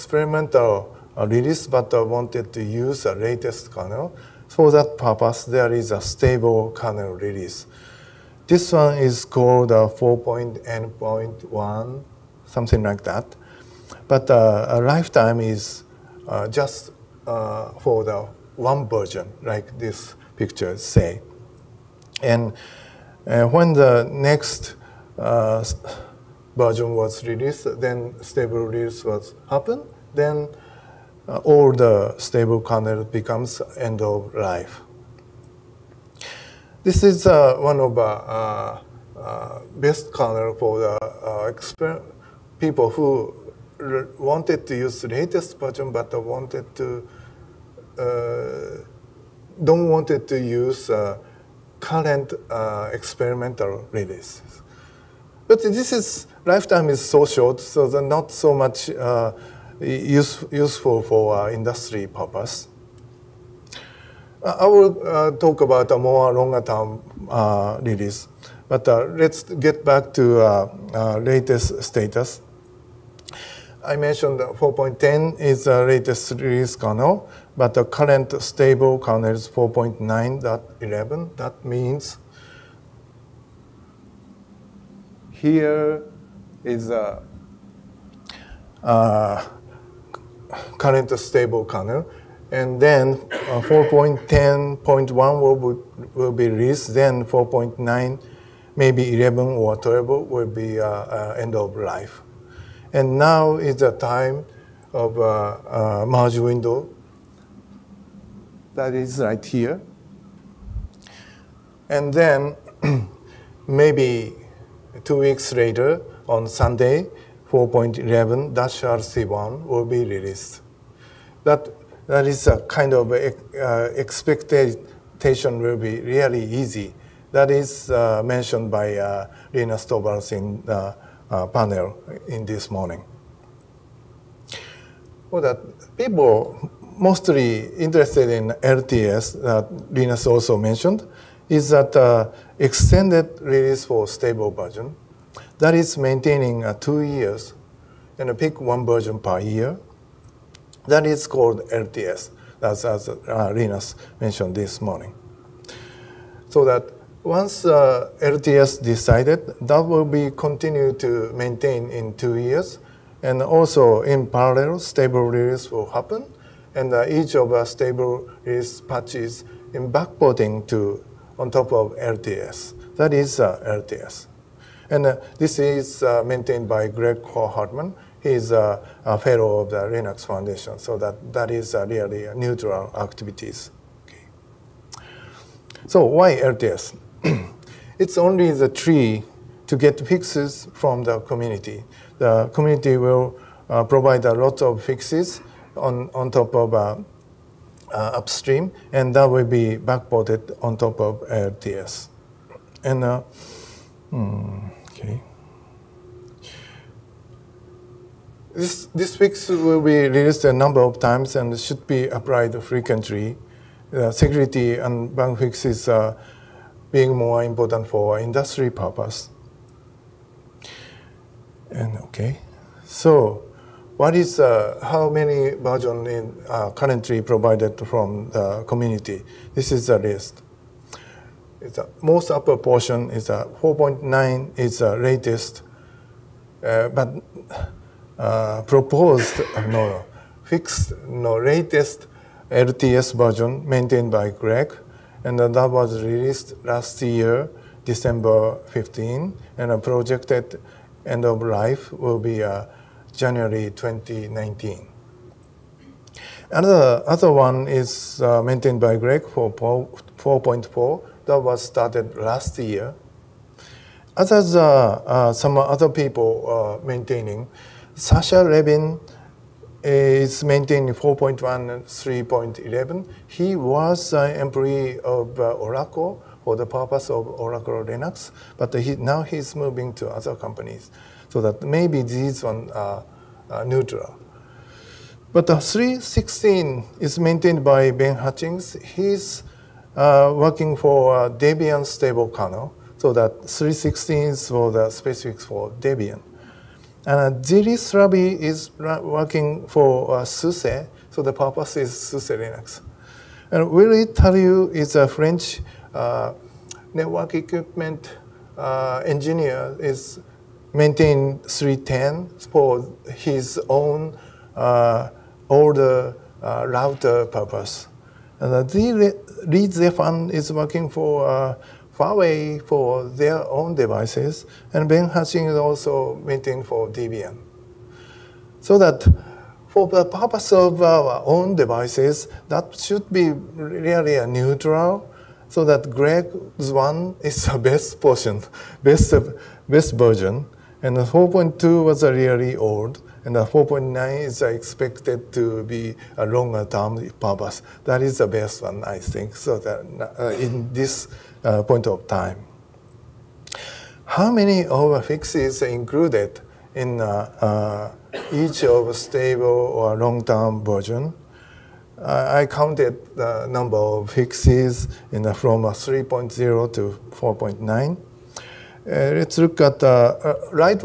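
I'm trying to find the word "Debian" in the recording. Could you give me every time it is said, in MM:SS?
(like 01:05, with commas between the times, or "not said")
04:51, 04:55, 05:26.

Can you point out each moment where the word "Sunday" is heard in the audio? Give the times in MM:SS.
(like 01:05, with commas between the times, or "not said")
01:56.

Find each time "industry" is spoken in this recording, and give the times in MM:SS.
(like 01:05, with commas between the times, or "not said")
01:01, 03:38.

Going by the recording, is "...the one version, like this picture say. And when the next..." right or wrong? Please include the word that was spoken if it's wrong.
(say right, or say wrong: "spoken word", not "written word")
right.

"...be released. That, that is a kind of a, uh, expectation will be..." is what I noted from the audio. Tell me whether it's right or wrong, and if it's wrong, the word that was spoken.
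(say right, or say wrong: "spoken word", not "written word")
right.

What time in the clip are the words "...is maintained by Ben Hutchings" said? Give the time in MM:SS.
04:46.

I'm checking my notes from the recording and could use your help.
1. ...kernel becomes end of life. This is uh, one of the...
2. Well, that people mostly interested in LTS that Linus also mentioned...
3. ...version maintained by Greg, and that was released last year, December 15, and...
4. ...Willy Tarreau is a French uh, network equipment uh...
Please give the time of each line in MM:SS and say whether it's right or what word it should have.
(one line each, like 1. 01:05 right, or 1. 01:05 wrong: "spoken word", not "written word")
1. 00:32 right
2. 02:15 right
3. 04:03 right
4. 05:03 right.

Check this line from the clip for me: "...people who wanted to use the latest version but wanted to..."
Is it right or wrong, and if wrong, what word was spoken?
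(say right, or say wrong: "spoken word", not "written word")
right.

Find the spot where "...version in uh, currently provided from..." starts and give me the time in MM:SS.
03:45.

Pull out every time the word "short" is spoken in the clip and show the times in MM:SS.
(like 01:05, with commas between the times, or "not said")
00:57.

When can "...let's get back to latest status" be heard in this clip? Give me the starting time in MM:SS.
01:08.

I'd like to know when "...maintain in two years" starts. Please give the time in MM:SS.
02:41.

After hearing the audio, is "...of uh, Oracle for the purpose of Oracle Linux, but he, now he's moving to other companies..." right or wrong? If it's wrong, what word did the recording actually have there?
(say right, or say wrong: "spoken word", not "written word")
right.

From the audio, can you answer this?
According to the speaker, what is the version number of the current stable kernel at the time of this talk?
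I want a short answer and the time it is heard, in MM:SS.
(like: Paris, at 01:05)
4.9.11, at 01:19.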